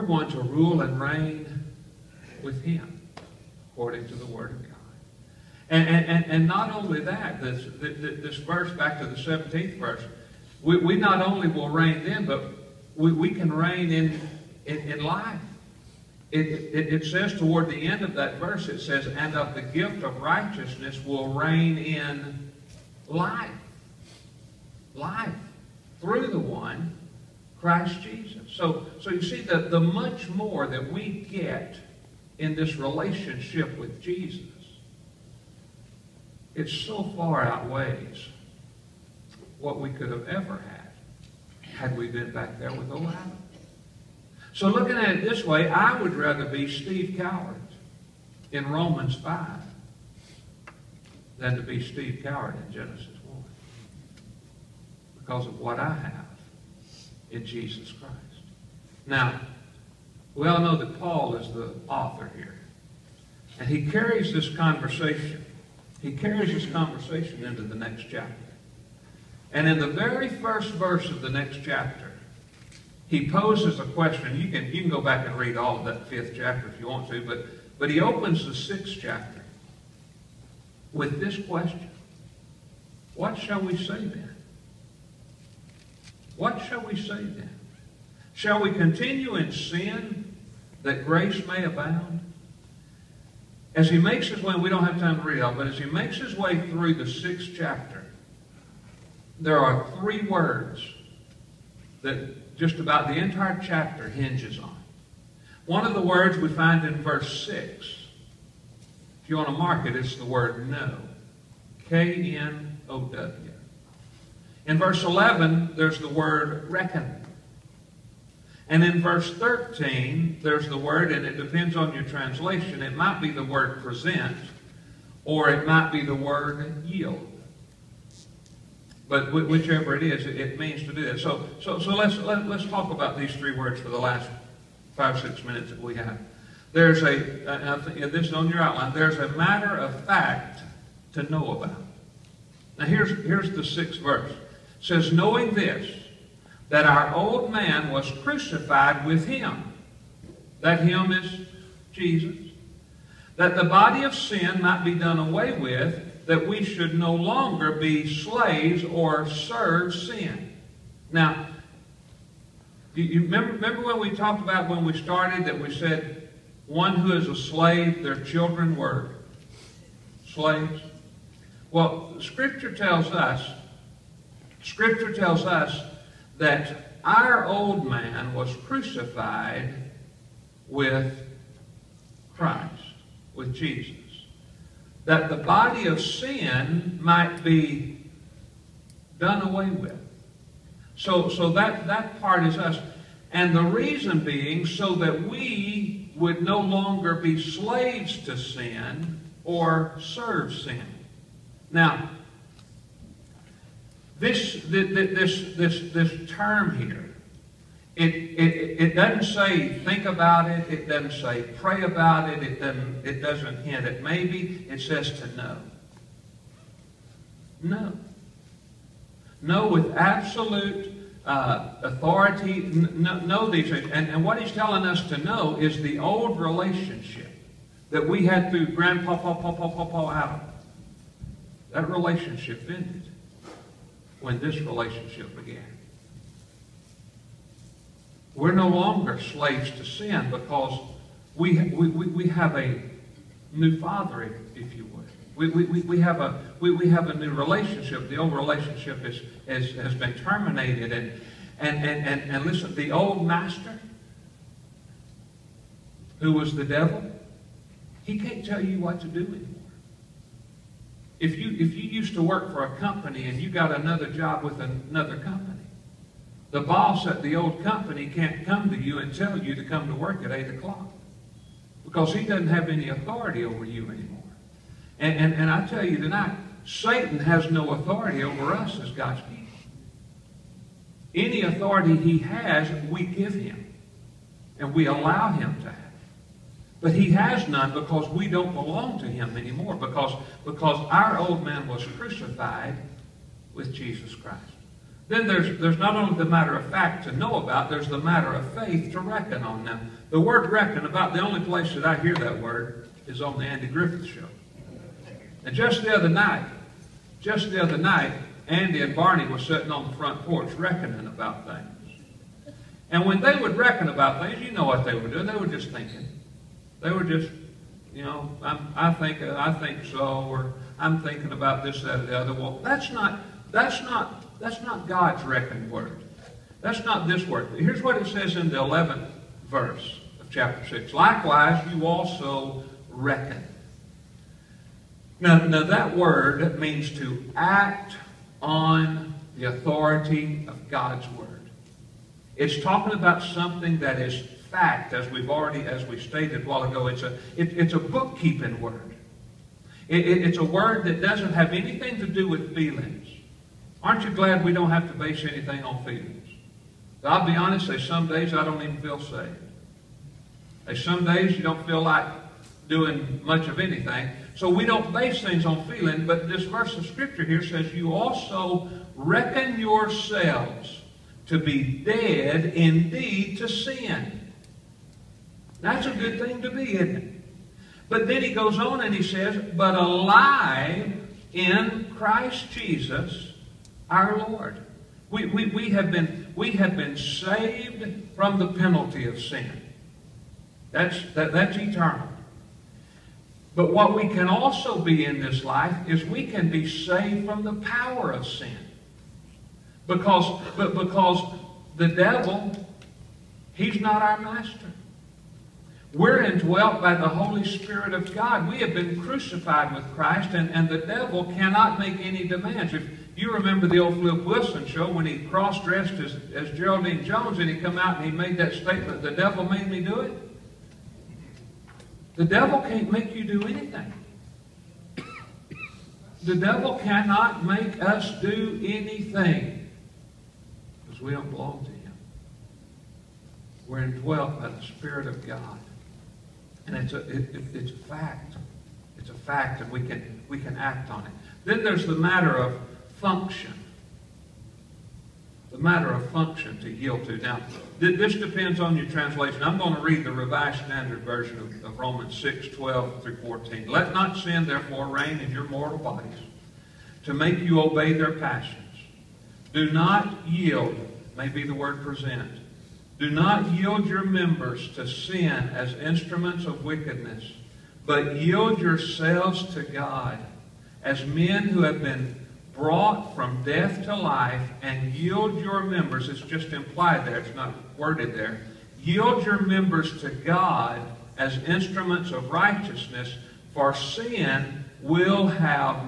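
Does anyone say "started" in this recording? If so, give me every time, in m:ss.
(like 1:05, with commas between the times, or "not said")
2:44.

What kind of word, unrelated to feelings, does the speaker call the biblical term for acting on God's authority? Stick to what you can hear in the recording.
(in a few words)
a bookkeeping word.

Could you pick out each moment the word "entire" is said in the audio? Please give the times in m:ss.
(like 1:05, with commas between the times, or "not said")
1:43.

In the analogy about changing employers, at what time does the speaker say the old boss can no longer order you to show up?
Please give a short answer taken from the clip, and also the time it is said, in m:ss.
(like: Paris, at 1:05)
8 o'clock, at 4:30.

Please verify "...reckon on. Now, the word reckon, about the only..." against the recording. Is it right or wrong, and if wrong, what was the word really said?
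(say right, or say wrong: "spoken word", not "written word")
right.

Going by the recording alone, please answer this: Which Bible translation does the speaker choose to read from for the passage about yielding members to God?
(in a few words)
Revised Standard Version.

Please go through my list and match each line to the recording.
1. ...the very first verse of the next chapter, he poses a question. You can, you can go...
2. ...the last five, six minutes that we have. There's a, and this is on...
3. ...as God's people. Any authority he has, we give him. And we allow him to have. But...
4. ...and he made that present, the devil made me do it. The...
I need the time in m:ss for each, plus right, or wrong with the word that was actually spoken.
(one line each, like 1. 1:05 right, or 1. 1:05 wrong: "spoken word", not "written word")
1. 1:09 right
2. 2:13 right
3. 4:38 right
4. 6:58 wrong: "statement", not "present".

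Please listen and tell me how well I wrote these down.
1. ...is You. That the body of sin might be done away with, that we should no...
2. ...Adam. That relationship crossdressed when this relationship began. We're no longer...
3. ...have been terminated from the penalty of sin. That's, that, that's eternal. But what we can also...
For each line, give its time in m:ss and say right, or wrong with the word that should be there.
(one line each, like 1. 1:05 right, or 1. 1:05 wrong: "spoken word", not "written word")
1. 2:31 wrong: "Jesus", not "You"
2. 3:50 wrong: "ended", not "crossdressed"
3. 6:26 wrong: "saved", not "terminated".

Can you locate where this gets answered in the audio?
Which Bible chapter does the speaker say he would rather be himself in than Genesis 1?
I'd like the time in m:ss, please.
0:48.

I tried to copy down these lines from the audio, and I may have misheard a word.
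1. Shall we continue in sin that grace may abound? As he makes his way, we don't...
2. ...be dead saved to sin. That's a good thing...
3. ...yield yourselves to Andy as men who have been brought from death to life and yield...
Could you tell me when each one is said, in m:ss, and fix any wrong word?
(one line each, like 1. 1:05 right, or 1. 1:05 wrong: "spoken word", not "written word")
1. 1:28 right
2. 6:11 wrong: "indeed", not "saved"
3. 7:48 wrong: "God", not "Andy".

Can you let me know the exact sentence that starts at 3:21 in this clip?
Now, this, this, this, this, this term here, it, it, it doesn't say think about it.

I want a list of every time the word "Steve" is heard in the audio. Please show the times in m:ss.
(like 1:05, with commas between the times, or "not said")
0:46, 0:51.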